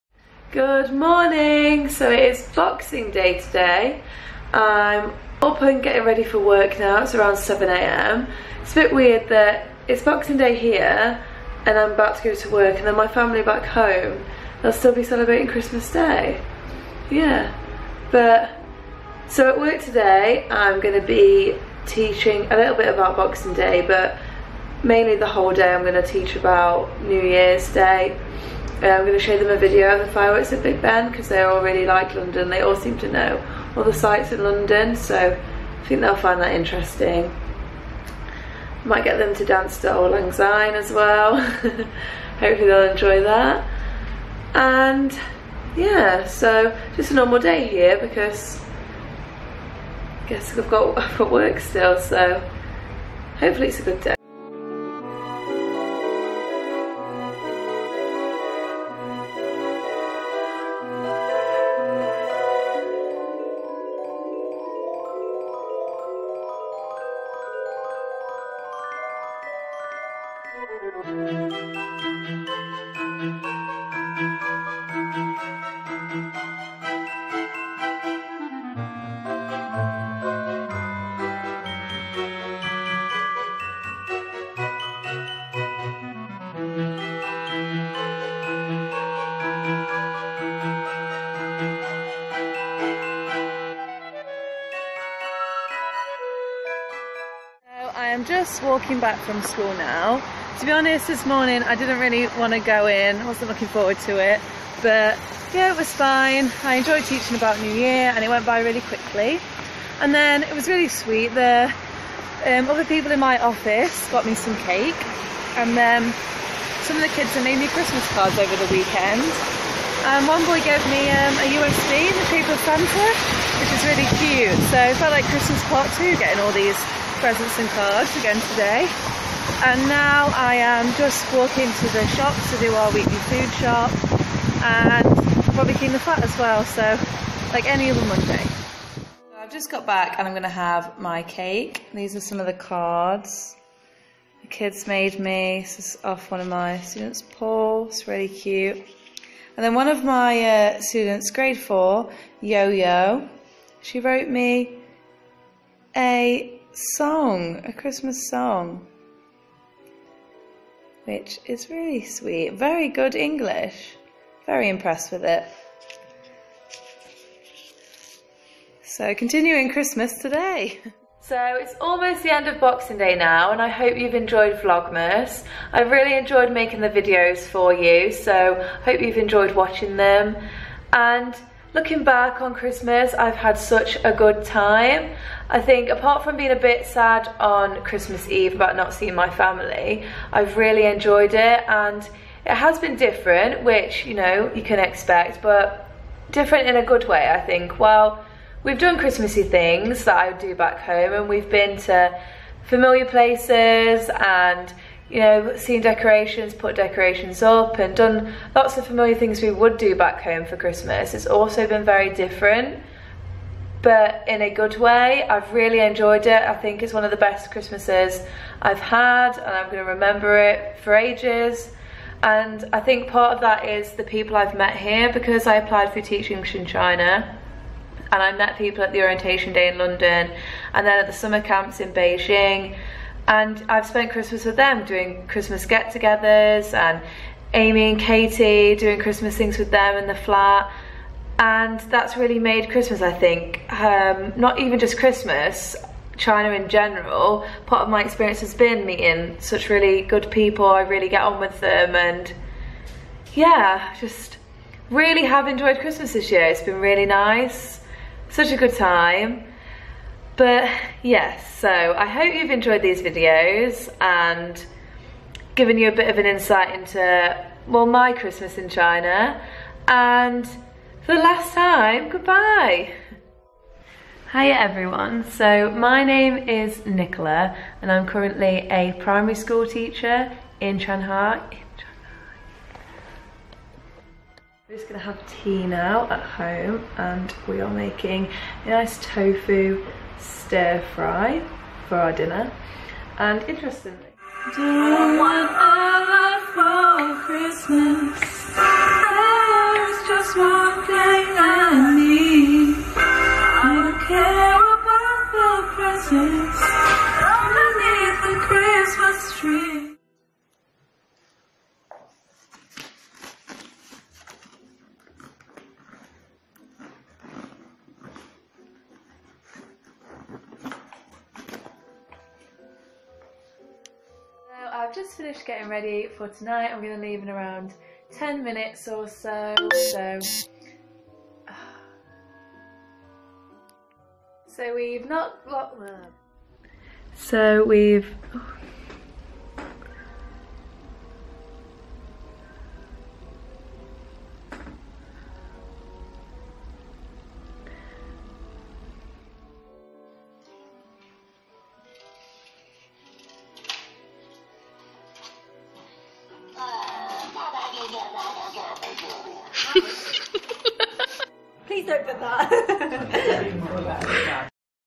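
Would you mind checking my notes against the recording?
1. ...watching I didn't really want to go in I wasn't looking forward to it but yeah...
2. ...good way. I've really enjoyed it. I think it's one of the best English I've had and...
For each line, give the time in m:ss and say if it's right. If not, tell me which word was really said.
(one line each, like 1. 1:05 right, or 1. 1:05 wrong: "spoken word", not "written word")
1. 1:41 wrong: "morning", not "watching"
2. 3:34 wrong: "Christmases", not "English".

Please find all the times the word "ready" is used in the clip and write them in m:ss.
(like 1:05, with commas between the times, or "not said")
0:06, 5:25.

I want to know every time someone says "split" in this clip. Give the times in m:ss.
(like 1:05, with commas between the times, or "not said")
not said.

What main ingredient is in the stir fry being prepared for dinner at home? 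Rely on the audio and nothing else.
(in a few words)
Tofu.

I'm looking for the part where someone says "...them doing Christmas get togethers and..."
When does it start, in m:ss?
3:54.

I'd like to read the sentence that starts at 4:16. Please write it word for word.
It's been really nice, such a good time.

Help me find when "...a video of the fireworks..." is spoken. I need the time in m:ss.
0:29.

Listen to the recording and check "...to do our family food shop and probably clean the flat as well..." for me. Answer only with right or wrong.
wrong.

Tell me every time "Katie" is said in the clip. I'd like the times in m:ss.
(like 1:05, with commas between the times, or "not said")
3:57.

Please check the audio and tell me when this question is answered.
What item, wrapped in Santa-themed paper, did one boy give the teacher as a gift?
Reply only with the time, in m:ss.
2:01.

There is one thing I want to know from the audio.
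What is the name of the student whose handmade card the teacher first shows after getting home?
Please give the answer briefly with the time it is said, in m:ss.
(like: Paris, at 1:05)
Paul, at 2:27.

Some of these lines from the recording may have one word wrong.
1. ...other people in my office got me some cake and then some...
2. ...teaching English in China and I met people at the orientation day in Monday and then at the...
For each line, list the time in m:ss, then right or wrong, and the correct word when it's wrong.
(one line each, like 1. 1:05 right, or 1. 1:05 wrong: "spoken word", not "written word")
1. 1:52 right
2. 3:46 wrong: "London", not "Monday".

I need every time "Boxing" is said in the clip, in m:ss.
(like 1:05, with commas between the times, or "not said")
0:02, 0:10, 0:23, 2:52.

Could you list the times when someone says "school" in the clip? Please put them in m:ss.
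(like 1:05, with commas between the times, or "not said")
1:39, 4:39.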